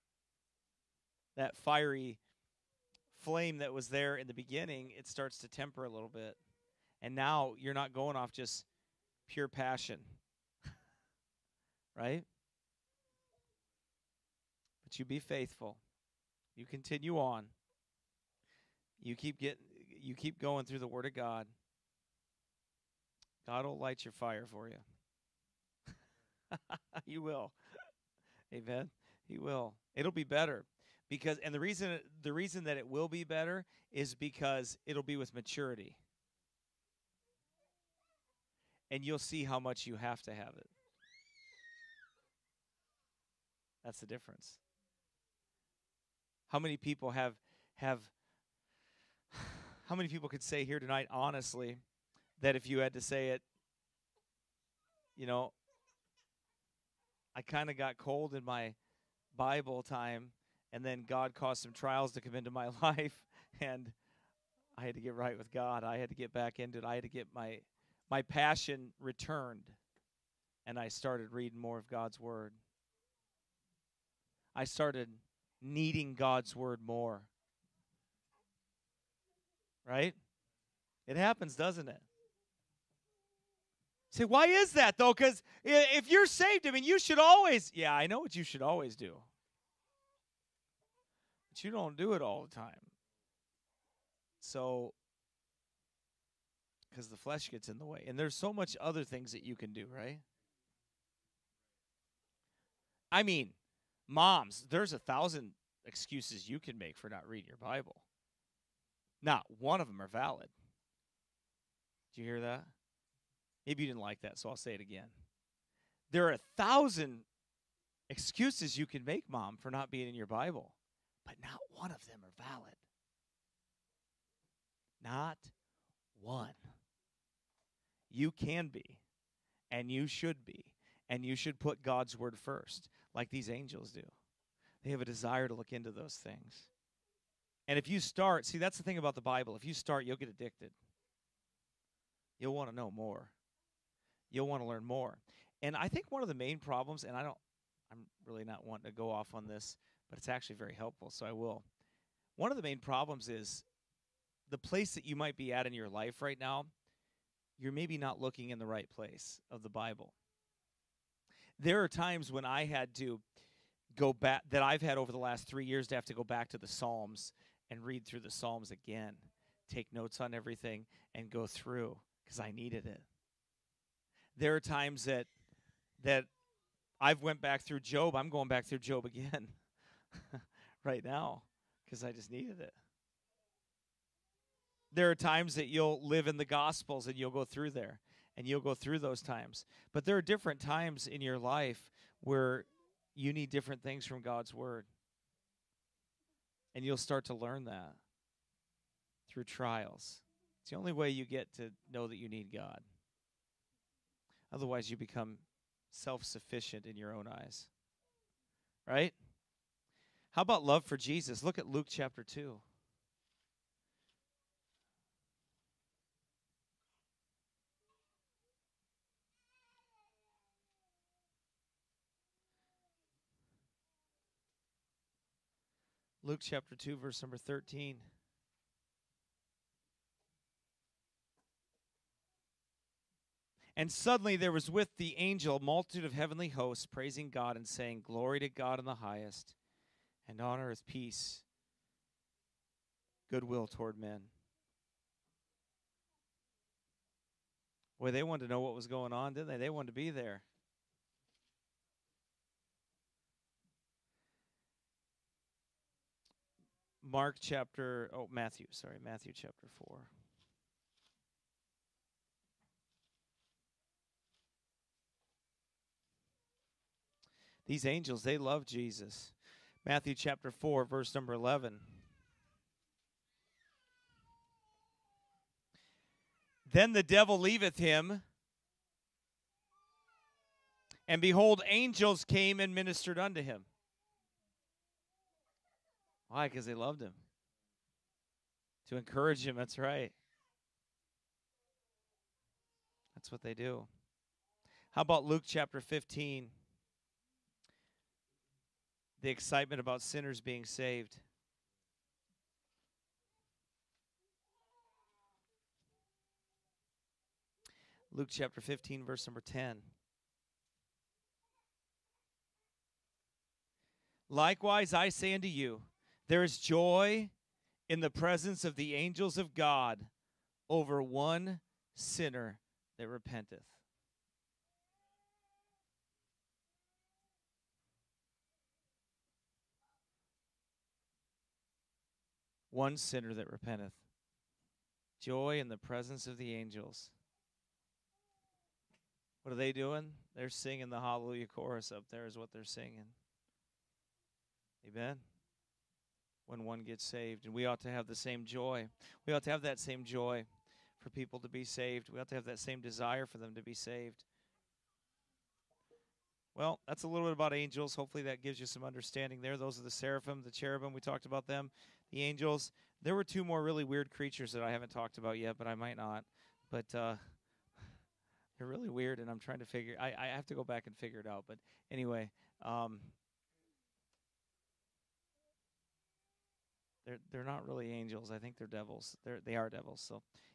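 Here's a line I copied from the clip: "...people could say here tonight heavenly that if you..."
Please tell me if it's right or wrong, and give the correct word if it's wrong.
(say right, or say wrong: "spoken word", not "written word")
wrong: "honestly", not "heavenly".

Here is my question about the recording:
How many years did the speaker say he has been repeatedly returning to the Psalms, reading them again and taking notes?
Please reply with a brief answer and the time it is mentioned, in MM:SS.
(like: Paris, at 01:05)
3, at 02:45.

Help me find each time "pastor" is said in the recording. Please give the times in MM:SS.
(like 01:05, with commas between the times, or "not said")
not said.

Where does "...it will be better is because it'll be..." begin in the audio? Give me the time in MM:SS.
00:32.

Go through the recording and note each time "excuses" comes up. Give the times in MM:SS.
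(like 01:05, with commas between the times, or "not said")
01:45, 01:58.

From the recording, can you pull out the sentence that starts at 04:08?
Boy, they wanted to know what was going on, didn't they?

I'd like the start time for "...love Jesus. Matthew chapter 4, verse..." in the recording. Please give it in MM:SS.
04:28.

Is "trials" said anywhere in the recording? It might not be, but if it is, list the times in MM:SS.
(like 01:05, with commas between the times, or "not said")
01:01, 03:19.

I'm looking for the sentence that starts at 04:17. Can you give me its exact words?
Mark chapter, oh, Matthew, sorry, Matthew chapter 4.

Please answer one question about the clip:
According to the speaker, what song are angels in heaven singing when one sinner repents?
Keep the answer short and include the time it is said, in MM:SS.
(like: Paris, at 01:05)
the hallelujah chorus, at 05:41.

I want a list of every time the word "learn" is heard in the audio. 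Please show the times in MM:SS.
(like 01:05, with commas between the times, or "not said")
02:24, 03:17.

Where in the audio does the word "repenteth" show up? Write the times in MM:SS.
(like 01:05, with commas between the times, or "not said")
05:23, 05:33.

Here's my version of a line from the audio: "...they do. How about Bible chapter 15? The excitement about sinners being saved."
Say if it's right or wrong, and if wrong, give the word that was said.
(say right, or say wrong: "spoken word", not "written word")
wrong: "Luke", not "Bible".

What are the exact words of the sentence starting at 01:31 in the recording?
But you don't do it all the time.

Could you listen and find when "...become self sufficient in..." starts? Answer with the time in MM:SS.
03:24.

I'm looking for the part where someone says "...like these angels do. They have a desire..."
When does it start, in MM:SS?
02:13.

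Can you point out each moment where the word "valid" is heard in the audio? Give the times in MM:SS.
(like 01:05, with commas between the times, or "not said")
01:50, 02:02.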